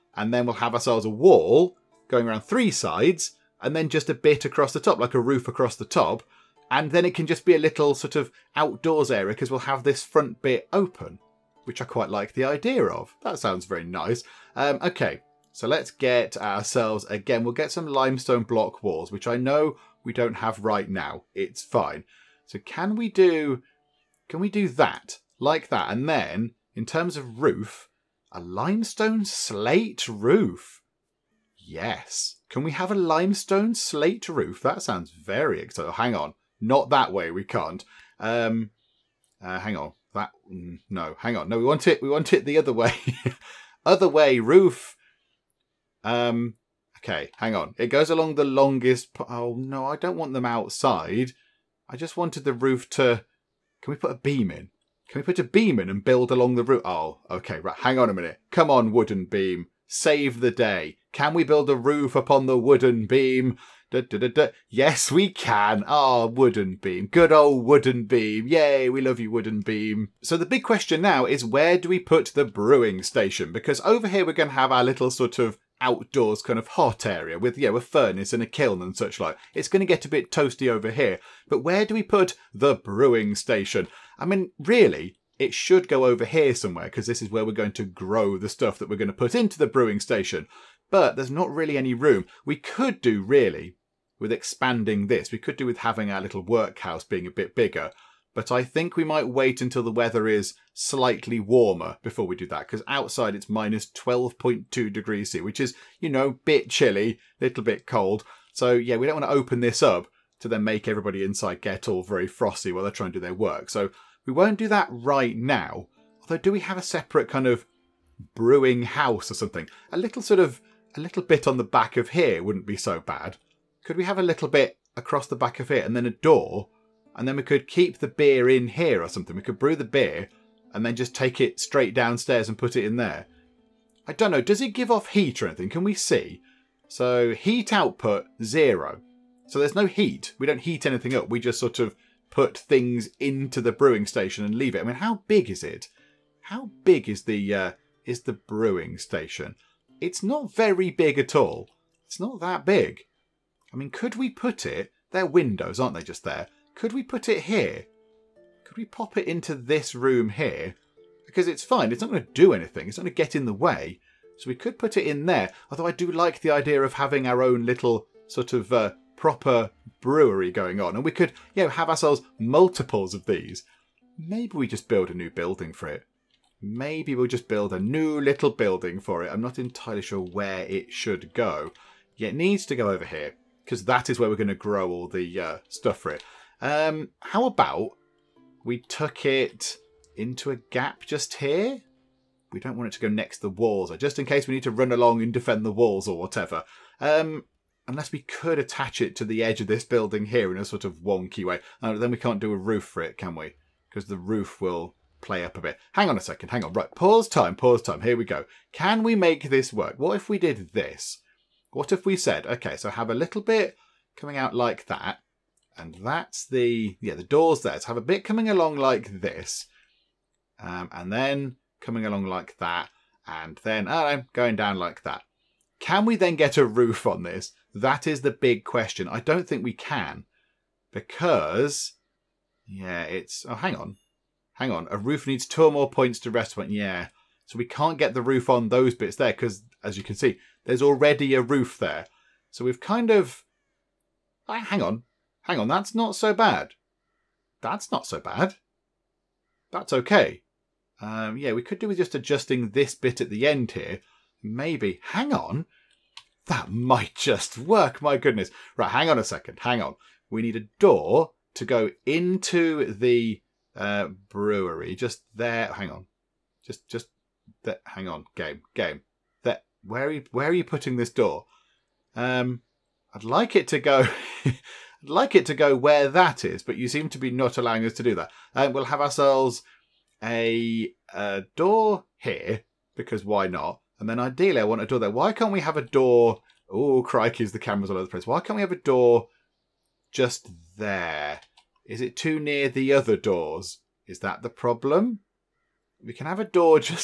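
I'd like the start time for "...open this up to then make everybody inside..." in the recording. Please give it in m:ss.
1:49.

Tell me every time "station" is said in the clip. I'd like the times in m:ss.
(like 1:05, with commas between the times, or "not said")
1:13, 1:23, 1:29, 2:24, 2:28.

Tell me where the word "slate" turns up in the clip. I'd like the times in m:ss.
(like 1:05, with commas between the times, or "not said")
0:29, 0:33.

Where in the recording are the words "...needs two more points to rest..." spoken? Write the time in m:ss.
3:55.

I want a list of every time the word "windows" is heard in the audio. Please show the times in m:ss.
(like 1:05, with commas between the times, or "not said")
2:35.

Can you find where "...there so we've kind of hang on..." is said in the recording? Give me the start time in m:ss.
4:01.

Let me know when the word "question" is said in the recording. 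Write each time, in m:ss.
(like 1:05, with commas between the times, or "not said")
1:10, 3:48.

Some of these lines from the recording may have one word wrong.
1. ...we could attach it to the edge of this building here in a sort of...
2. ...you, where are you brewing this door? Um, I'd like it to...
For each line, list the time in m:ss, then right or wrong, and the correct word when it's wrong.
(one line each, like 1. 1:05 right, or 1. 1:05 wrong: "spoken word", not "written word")
1. 3:18 right
2. 4:30 wrong: "putting", not "brewing".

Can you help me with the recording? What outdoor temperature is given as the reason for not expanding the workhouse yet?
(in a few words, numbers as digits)
-12.2 degrees C.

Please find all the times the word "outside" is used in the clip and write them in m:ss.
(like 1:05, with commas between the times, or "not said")
0:50, 1:42.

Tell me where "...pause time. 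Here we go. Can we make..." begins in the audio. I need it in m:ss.
3:27.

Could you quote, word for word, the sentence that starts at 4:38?
Um, we'll have ourselves a, a door here, because why not?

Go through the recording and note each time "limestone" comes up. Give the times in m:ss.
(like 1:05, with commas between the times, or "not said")
0:17, 0:28, 0:32.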